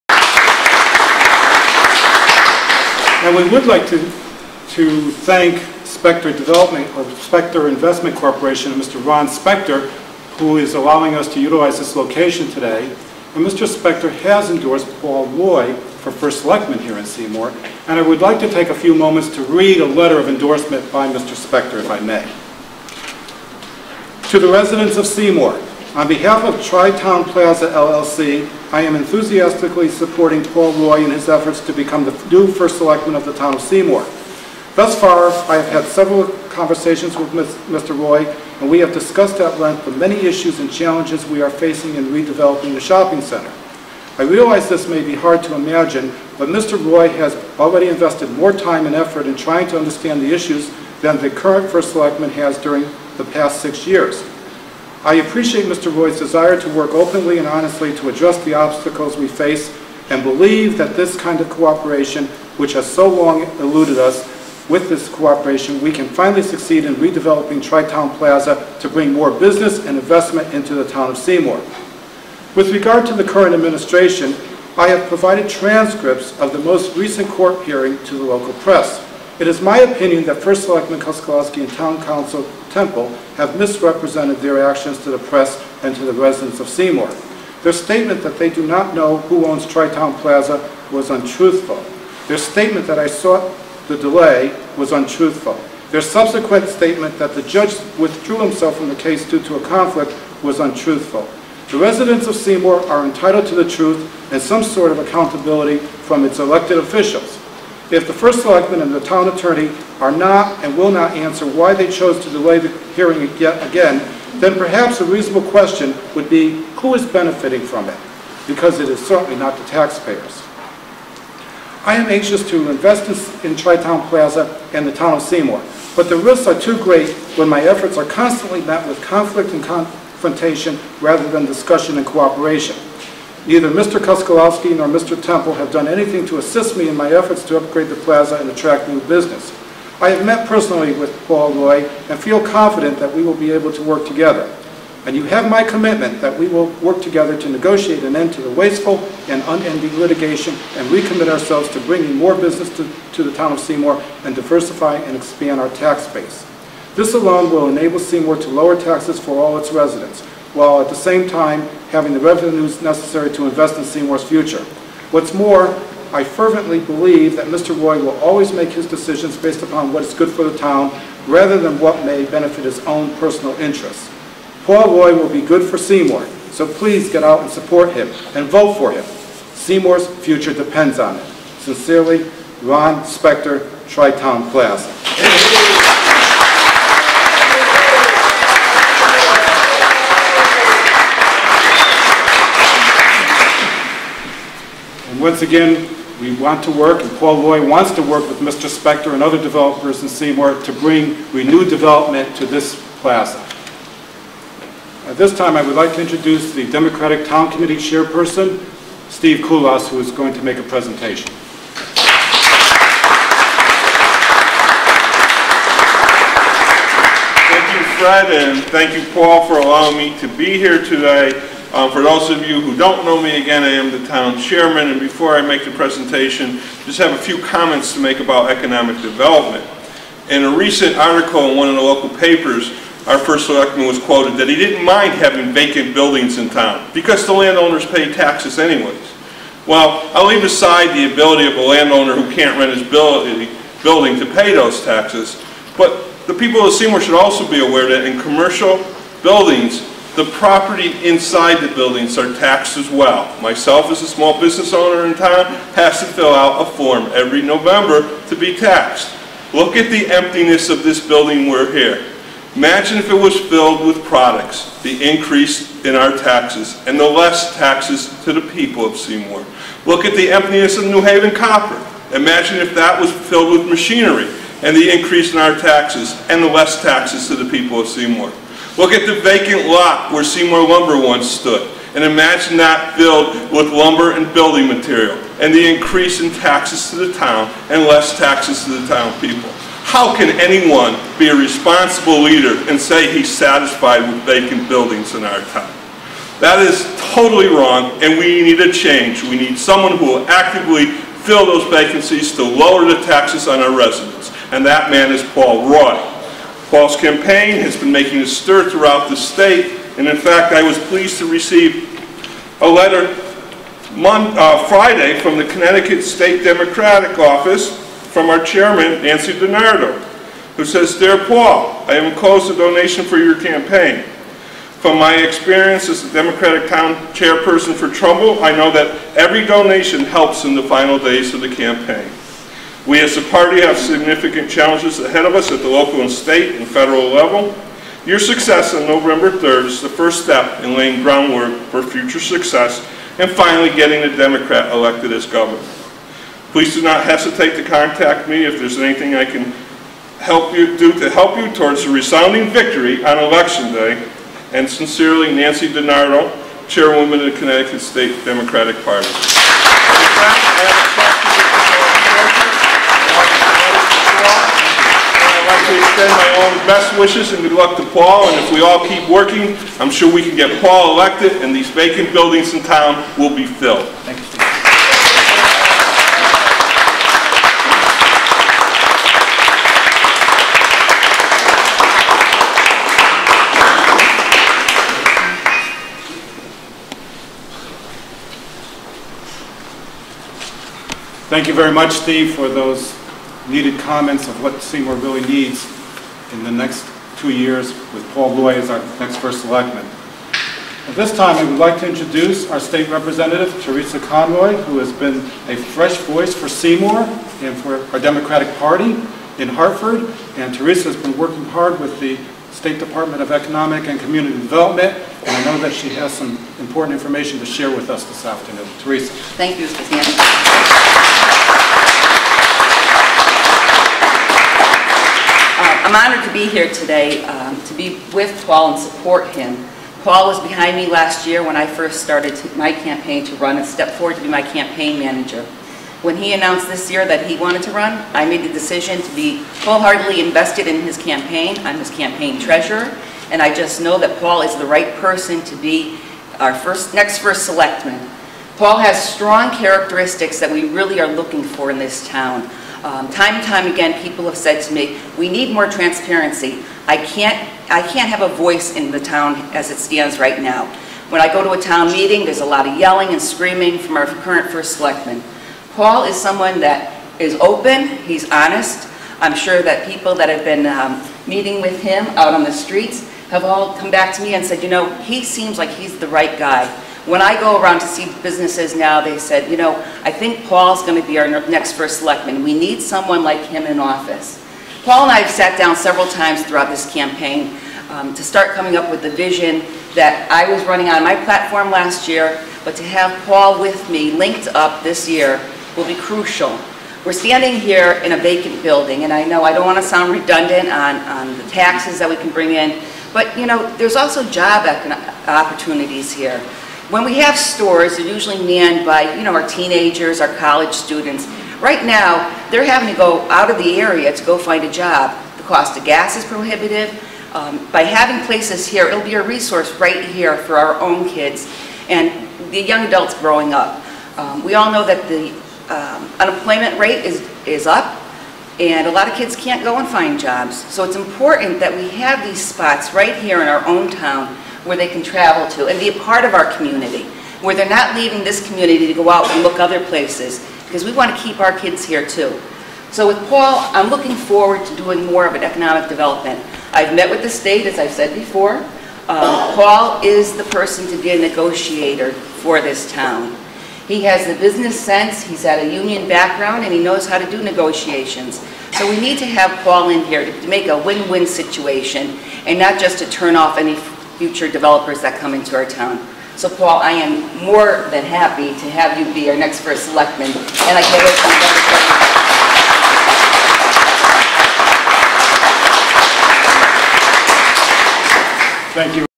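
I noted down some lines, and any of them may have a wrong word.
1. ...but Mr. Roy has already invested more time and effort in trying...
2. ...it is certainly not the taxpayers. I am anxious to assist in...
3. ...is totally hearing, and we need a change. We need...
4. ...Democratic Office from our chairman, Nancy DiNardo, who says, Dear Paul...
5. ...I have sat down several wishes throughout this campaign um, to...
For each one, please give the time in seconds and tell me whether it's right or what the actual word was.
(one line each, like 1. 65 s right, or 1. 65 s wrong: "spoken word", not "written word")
1. 46 s right
2. 118 s wrong: "invest", not "assist"
3. 296 s wrong: "wrong", not "hearing"
4. 316 s right
5. 485 s wrong: "times", not "wishes".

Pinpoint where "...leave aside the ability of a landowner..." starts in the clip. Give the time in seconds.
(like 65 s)
240 s.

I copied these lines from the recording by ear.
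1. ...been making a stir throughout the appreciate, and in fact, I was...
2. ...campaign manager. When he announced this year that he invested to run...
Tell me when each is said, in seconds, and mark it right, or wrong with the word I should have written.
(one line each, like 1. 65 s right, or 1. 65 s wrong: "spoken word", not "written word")
1. 307 s wrong: "state", not "appreciate"
2. 434 s wrong: "wanted", not "invested".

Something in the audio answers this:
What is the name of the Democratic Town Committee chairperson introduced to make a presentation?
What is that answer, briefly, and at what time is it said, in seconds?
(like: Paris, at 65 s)
Steve Kulas, at 209 s.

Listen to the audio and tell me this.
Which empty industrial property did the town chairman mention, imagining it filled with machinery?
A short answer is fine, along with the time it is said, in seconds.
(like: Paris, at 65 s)
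New Haven Copper, at 270 s.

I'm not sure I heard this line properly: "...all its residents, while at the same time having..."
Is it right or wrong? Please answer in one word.
right.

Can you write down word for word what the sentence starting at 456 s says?
I can't, I can't have a voice in the town as it stands right now.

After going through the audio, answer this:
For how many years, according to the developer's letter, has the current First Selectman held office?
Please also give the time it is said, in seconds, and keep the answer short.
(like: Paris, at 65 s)
6, at 53 s.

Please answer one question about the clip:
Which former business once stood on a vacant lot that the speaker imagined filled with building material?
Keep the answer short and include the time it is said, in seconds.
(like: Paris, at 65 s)
Seymour Lumber, at 280 s.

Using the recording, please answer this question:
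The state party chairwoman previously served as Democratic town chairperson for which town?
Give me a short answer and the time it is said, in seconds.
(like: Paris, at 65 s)
Trumbull, at 327 s.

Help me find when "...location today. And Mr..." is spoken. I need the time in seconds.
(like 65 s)
11 s.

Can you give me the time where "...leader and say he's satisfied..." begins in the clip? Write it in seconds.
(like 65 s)
292 s.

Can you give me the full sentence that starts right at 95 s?
Their subsequent statement that the judge withdrew himself from the case due to a conflict was untruthful.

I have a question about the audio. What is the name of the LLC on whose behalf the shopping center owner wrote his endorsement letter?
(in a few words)
Tri-Town Plaza LLC.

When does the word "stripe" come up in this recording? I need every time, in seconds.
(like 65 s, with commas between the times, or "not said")
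not said.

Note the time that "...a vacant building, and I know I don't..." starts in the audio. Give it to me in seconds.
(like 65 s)
498 s.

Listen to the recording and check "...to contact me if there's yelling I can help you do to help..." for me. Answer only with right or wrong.
wrong.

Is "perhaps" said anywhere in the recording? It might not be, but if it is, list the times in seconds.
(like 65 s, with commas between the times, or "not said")
114 s.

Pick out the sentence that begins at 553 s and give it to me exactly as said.
He has the business sense, he's had a union background, and he knows how to do negotiations.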